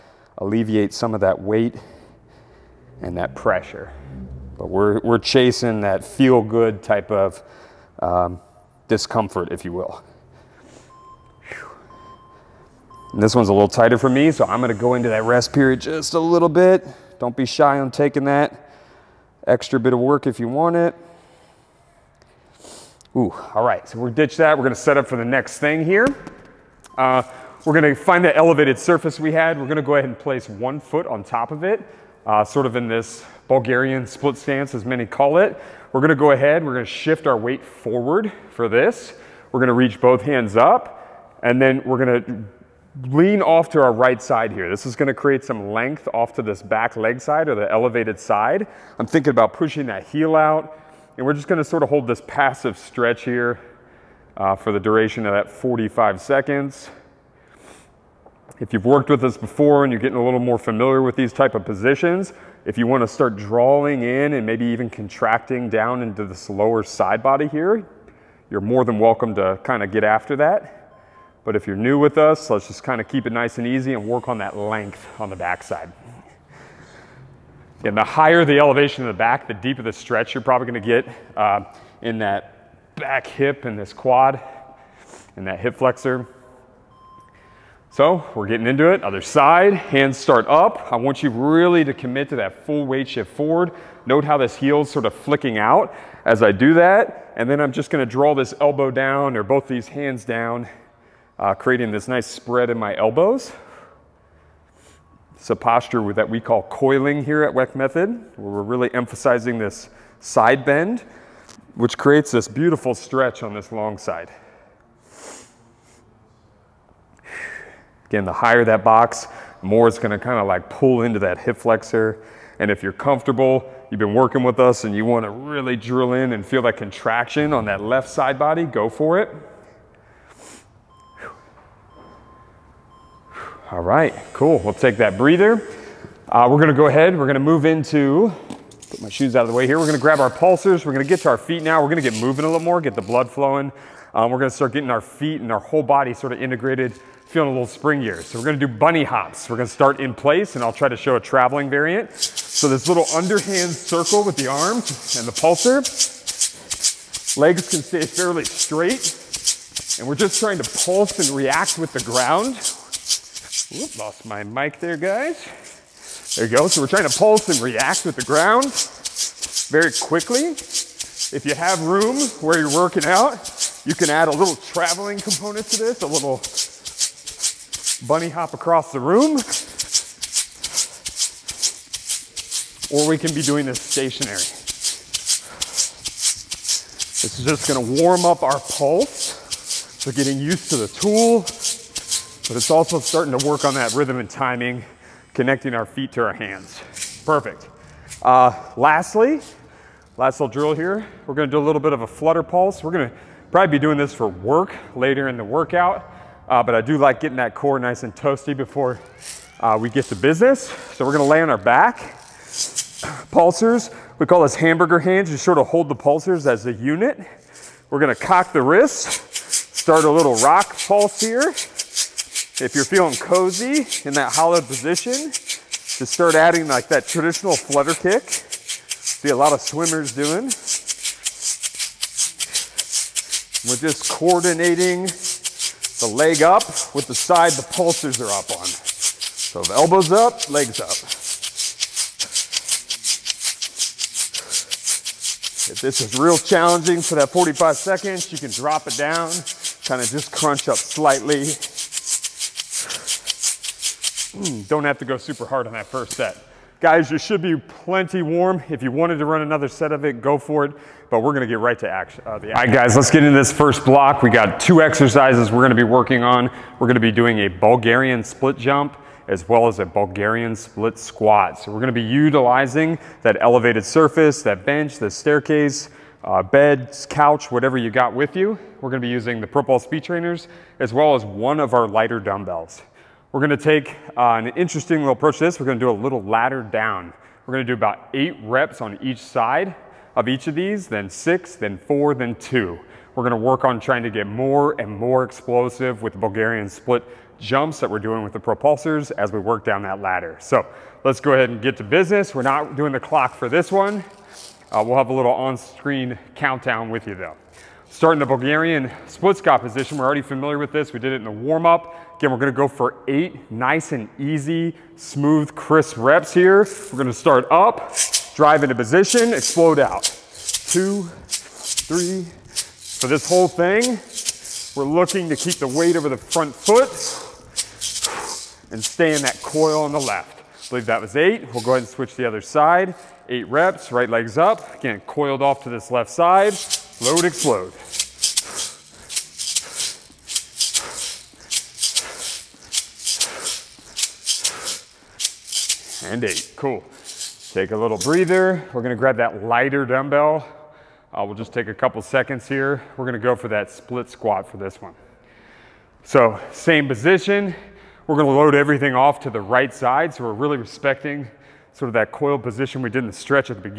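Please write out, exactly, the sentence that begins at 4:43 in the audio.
We're gonna take uh, an interesting little approach to this.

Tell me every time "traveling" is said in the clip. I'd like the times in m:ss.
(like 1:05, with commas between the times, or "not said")
2:31, 2:54.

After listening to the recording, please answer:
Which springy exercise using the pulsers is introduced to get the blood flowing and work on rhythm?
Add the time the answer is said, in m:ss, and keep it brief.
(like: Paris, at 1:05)
bunny hops, at 2:28.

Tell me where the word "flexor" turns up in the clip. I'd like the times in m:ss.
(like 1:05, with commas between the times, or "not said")
1:25, 2:01.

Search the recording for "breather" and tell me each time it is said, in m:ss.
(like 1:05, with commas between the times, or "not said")
2:15, 5:47.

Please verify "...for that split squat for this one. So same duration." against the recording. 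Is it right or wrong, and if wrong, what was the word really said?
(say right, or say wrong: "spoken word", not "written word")
wrong: "position", not "duration".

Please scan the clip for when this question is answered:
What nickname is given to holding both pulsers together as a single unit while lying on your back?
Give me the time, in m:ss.
3:34.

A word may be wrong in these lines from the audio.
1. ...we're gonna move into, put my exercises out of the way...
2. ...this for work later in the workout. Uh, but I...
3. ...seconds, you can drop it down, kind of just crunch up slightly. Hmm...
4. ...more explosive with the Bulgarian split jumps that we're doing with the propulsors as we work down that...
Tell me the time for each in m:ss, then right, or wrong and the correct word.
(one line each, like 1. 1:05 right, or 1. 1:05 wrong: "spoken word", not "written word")
1. 2:17 wrong: "shoes", not "exercises"
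2. 3:23 right
3. 4:07 right
4. 4:54 right.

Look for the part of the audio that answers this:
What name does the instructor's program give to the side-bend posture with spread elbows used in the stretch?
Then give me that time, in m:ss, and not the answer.
1:46.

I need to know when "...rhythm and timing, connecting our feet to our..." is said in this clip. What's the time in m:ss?
3:13.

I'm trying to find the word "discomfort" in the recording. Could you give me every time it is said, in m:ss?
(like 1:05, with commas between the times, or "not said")
0:08.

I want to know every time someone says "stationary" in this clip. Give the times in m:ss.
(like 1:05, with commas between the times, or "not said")
3:03.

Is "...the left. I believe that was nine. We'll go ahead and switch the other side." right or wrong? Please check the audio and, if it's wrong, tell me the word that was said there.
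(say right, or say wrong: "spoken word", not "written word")
wrong: "eight", not "nine".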